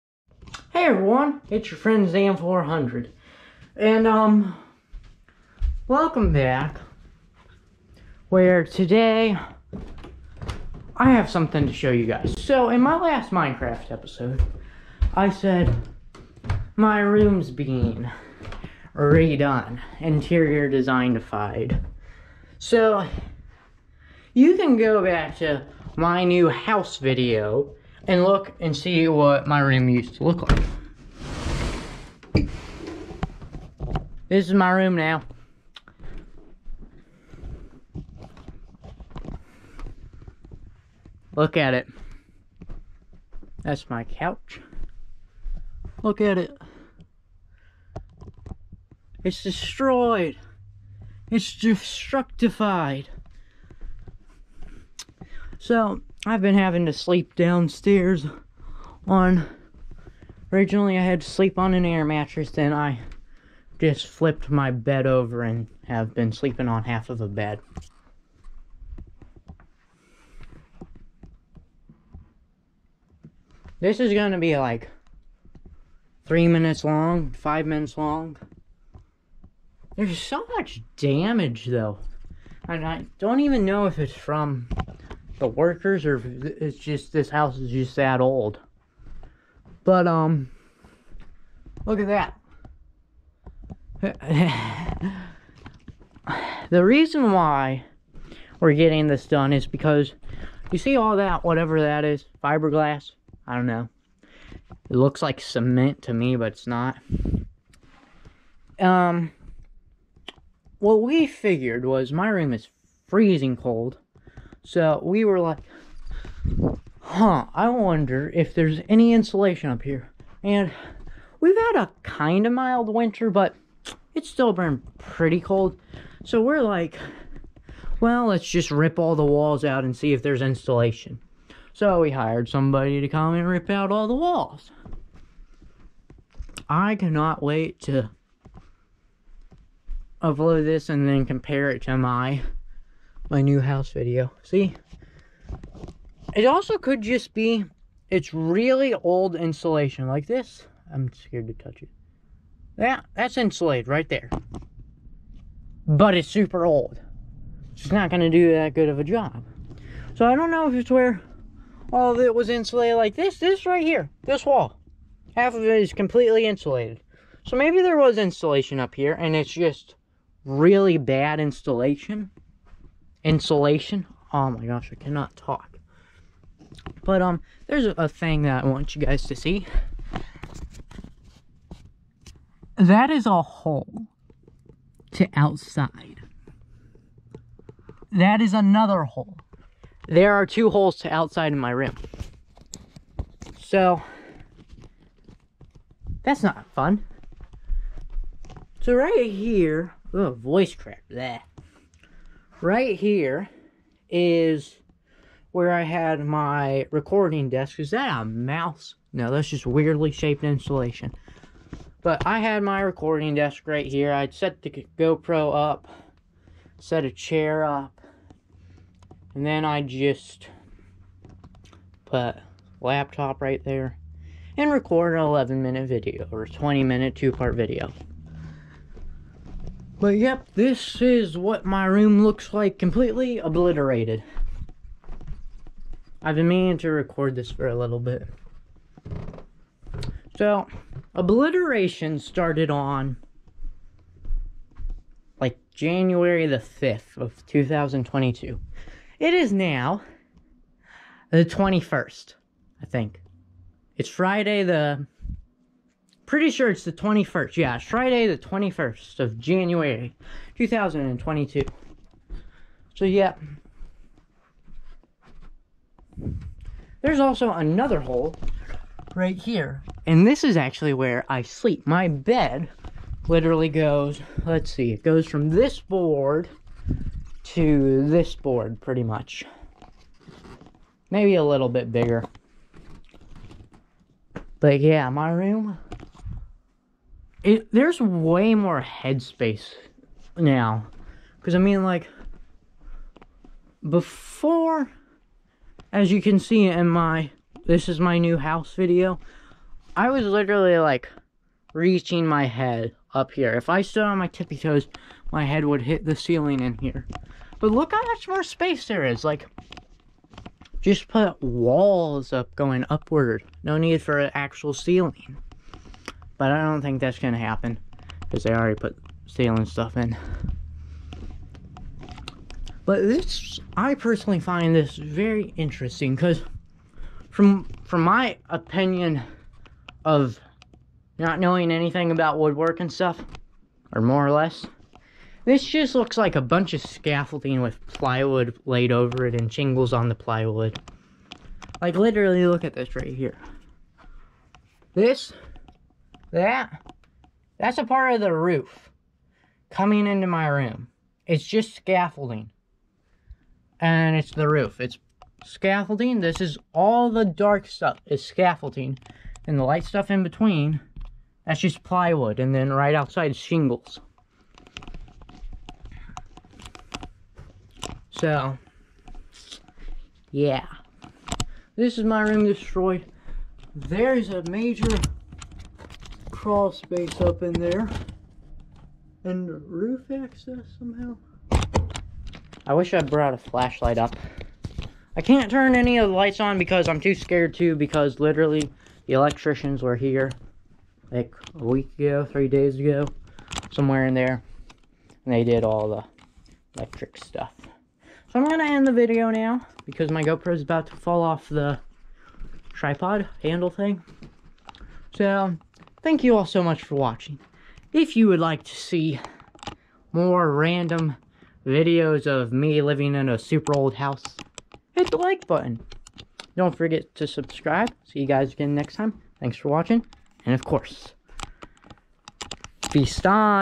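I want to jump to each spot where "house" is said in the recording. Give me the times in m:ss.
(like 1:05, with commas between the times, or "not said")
0:26, 1:27, 2:23, 4:58, 6:53.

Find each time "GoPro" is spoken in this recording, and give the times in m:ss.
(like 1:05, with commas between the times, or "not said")
3:34, 6:40.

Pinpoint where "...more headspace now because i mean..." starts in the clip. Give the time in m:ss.
4:48.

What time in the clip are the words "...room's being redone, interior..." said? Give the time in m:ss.
0:17.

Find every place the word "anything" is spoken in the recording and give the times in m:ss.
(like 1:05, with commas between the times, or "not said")
5:31.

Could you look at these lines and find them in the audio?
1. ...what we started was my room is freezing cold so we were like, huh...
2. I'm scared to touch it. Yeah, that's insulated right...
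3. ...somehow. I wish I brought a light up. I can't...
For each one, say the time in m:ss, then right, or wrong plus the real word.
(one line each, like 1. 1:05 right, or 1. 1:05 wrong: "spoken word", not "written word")
1. 1:50 wrong: "figured", not "started"
2. 2:30 right
3. 6:20 wrong: "flashlight", not "light".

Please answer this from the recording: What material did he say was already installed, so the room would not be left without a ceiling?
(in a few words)
steel.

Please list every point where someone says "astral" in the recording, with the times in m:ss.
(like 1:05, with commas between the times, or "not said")
not said.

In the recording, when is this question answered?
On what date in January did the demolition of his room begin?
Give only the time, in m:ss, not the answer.
4:05.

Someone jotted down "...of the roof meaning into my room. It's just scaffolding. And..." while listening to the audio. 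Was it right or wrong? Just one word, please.
wrong.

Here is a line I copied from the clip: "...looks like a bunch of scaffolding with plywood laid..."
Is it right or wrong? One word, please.
right.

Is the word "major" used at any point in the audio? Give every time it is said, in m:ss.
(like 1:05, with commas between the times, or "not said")
6:14.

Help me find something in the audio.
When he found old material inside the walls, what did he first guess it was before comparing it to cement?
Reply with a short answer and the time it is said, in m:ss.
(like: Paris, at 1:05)
fiberglass, at 1:42.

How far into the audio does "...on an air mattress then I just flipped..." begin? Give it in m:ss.
1:01.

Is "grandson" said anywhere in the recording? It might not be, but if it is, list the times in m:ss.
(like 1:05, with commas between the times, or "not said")
not said.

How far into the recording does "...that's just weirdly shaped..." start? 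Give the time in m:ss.
3:29.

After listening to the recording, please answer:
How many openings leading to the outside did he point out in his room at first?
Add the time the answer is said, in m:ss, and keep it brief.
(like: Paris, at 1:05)
2, at 3:10.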